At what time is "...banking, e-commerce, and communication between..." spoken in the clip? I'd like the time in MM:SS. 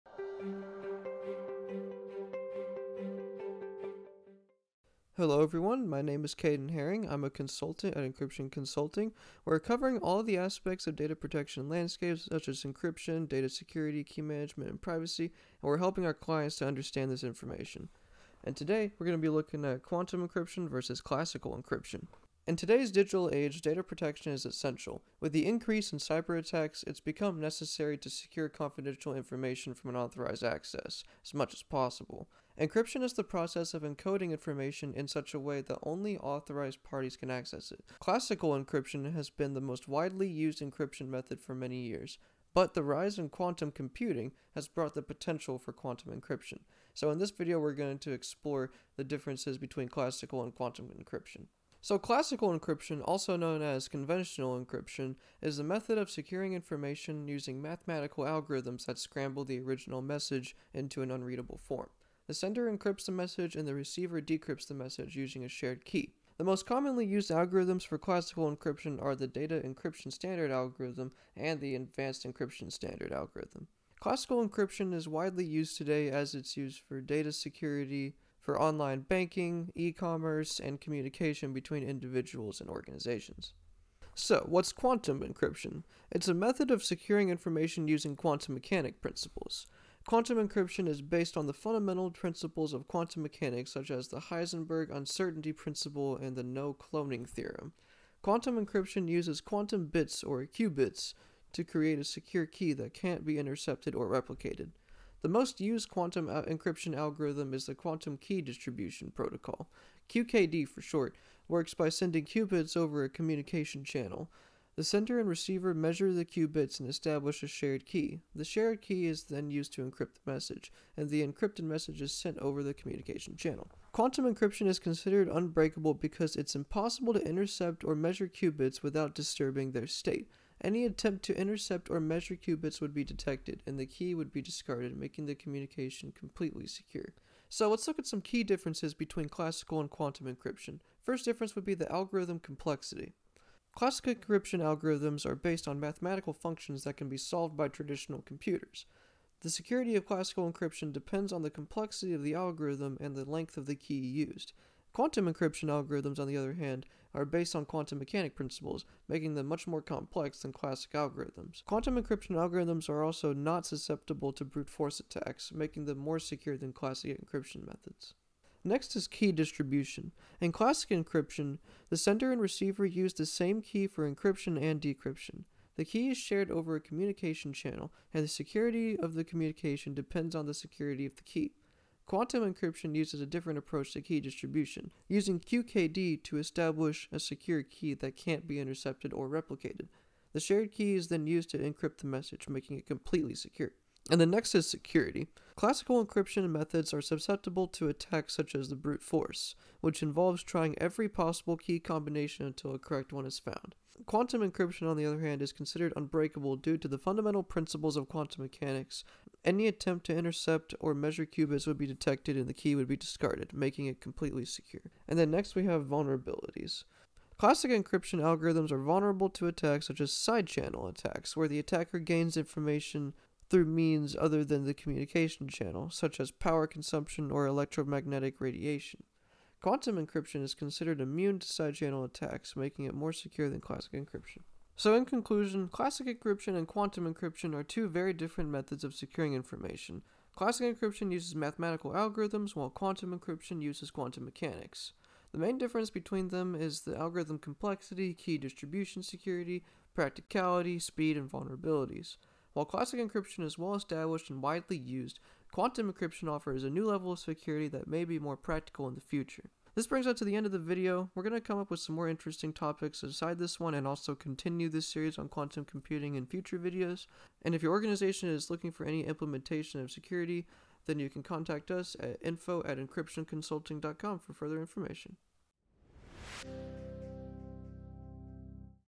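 01:19.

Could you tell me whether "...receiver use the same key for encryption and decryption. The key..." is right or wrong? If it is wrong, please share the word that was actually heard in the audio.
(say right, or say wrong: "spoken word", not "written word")
right.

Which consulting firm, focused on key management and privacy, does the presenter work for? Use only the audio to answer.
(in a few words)
Encryption Consulting.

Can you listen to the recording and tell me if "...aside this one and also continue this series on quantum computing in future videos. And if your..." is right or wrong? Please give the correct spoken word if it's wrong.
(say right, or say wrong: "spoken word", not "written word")
right.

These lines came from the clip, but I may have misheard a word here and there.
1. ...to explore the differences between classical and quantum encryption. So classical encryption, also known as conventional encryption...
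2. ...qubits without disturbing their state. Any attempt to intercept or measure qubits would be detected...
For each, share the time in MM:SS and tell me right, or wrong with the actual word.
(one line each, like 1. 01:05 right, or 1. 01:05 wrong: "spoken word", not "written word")
1. 00:47 right
2. 02:08 right.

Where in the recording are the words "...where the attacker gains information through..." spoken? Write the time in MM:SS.
03:41.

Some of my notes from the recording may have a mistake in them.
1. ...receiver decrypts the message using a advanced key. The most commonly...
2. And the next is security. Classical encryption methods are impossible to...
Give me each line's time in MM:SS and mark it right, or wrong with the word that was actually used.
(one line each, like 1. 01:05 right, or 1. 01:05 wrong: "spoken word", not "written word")
1. 01:03 wrong: "shared", not "advanced"
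2. 03:14 wrong: "susceptible", not "impossible".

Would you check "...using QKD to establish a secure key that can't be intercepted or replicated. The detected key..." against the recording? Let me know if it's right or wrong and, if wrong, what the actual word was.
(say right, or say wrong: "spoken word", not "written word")
wrong: "shared", not "detected".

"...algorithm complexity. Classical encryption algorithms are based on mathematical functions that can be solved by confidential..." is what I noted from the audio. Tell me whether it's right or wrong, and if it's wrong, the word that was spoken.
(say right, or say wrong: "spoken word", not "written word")
wrong: "traditional", not "confidential".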